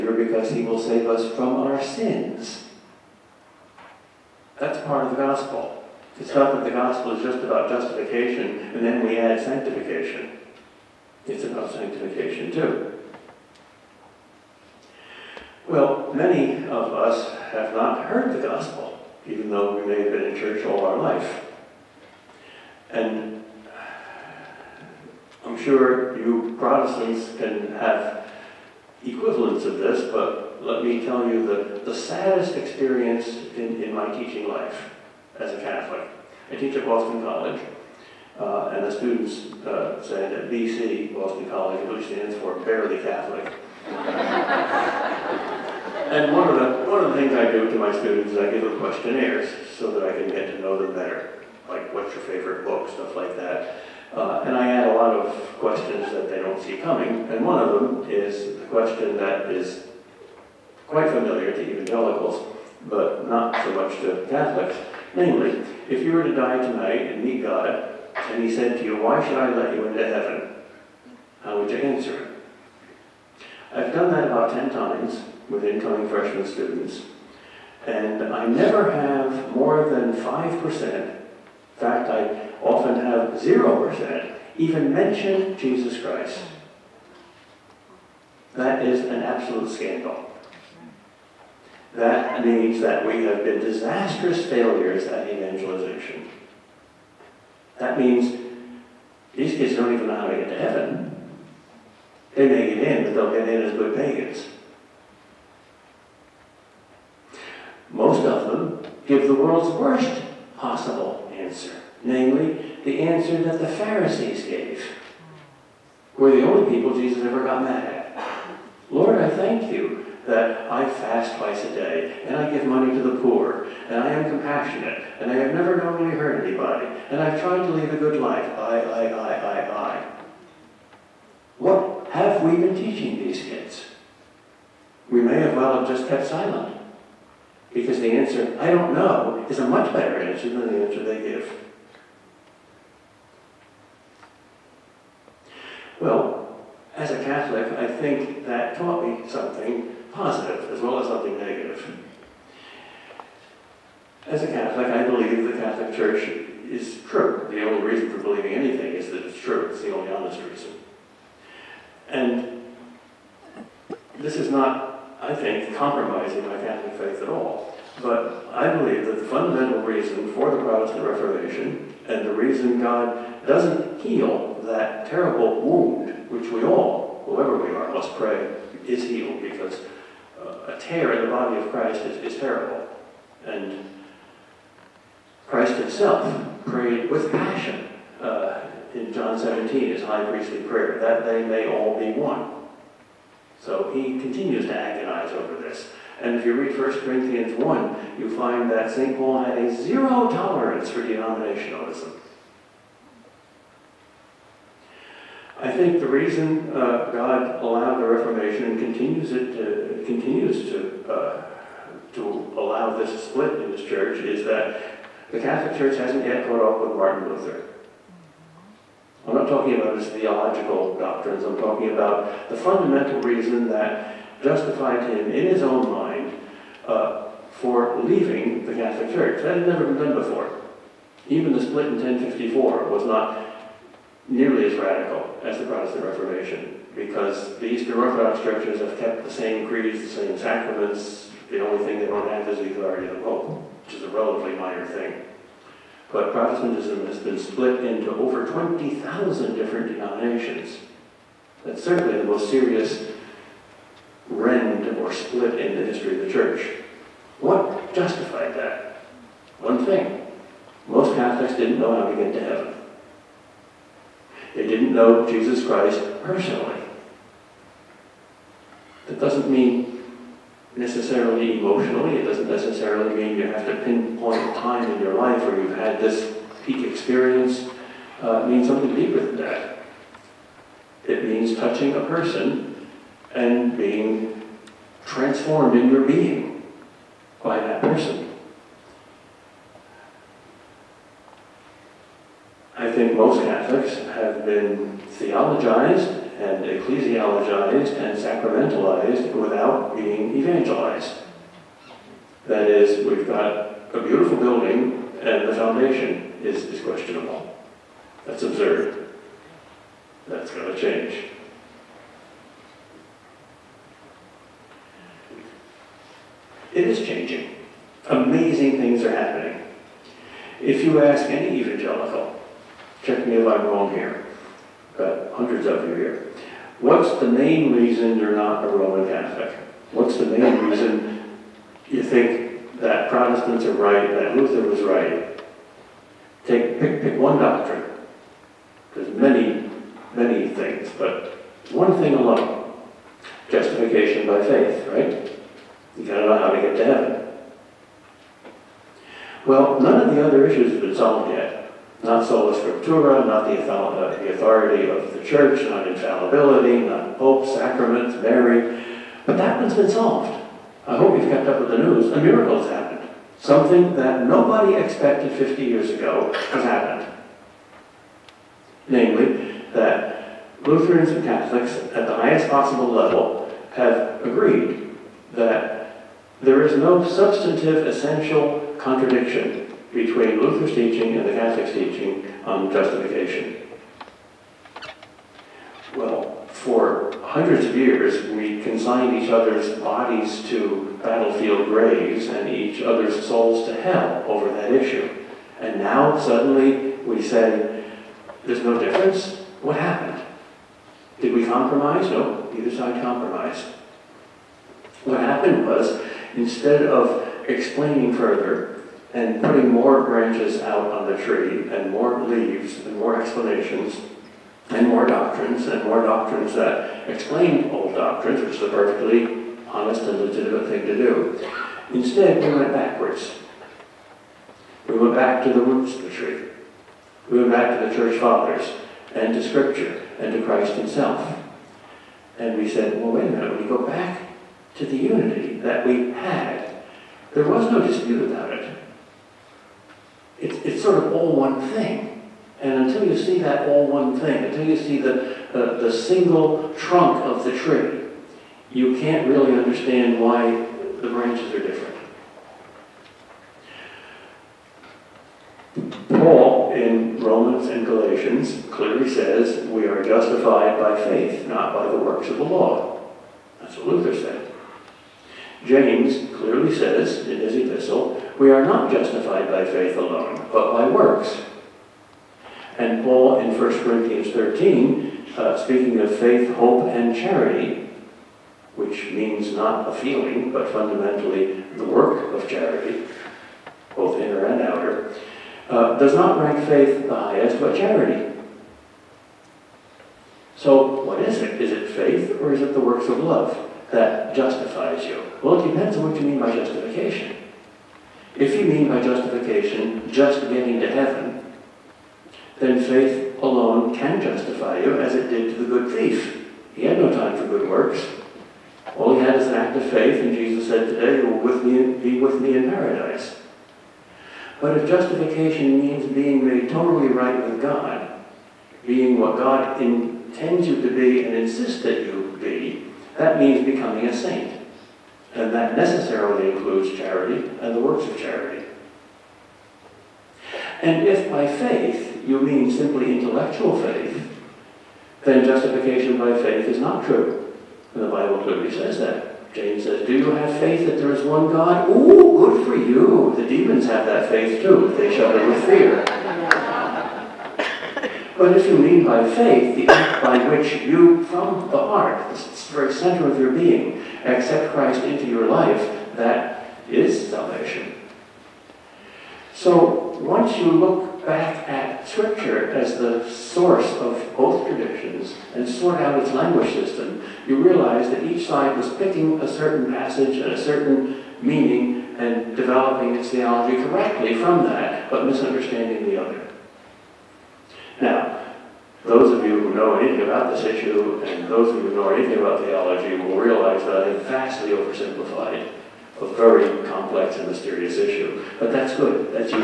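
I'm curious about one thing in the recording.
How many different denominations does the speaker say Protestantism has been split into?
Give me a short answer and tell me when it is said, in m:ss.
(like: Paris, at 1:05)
over 20,000, at 4:08.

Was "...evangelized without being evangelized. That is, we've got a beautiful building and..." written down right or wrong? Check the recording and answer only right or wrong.
wrong.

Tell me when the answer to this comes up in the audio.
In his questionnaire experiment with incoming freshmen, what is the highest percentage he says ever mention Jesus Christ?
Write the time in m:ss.
1:20.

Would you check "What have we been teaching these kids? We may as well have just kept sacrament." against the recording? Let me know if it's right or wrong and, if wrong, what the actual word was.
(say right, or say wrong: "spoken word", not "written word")
wrong: "silent", not "sacrament".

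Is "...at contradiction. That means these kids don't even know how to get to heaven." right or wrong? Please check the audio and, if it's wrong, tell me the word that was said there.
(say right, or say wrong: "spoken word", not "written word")
wrong: "evangelization", not "contradiction".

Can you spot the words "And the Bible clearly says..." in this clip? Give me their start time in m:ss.
8:57.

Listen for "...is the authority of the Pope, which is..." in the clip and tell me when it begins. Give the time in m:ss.
4:02.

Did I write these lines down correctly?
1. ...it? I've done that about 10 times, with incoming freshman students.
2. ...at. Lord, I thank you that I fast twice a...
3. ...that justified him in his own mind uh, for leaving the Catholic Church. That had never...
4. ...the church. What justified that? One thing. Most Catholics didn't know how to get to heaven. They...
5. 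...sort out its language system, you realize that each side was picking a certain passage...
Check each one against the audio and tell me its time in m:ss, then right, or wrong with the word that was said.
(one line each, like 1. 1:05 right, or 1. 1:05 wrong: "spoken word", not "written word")
1. 1:12 right
2. 1:57 right
3. 3:43 right
4. 4:16 right
5. 9:25 right.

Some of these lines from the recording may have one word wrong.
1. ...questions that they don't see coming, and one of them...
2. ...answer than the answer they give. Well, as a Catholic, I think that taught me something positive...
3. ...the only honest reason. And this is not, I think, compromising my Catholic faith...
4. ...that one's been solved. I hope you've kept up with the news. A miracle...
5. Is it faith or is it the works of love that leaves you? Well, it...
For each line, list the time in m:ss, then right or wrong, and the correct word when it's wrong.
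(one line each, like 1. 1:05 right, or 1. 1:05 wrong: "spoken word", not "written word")
1. 0:55 right
2. 2:20 right
3. 2:39 right
4. 5:59 right
5. 8:11 wrong: "justifies", not "leaves".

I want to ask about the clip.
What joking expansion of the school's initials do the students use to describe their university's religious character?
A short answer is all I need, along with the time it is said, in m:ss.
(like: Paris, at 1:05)
Barely Catholic, at 0:42.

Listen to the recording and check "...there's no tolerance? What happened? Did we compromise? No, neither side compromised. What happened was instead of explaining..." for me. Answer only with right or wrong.
wrong.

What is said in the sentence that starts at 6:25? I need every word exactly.
Well, for hundreds of years, we consigned each other's bodies to battlefield graves and each other's souls to hell over that issue.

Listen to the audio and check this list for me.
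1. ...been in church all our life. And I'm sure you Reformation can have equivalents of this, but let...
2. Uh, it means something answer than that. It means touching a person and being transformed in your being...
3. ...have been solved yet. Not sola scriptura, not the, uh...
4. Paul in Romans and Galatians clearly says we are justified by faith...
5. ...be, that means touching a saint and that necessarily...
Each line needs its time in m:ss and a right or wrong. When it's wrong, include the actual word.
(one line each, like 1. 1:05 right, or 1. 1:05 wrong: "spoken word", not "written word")
1. 0:20 wrong: "Protestants", not "Reformation"
2. 4:38 wrong: "deeper", not "answer"
3. 5:50 right
4. 7:36 right
5. 8:42 wrong: "becoming", not "touching".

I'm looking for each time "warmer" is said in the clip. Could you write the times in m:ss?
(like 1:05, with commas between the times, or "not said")
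not said.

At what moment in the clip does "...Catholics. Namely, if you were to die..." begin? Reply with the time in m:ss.
1:04.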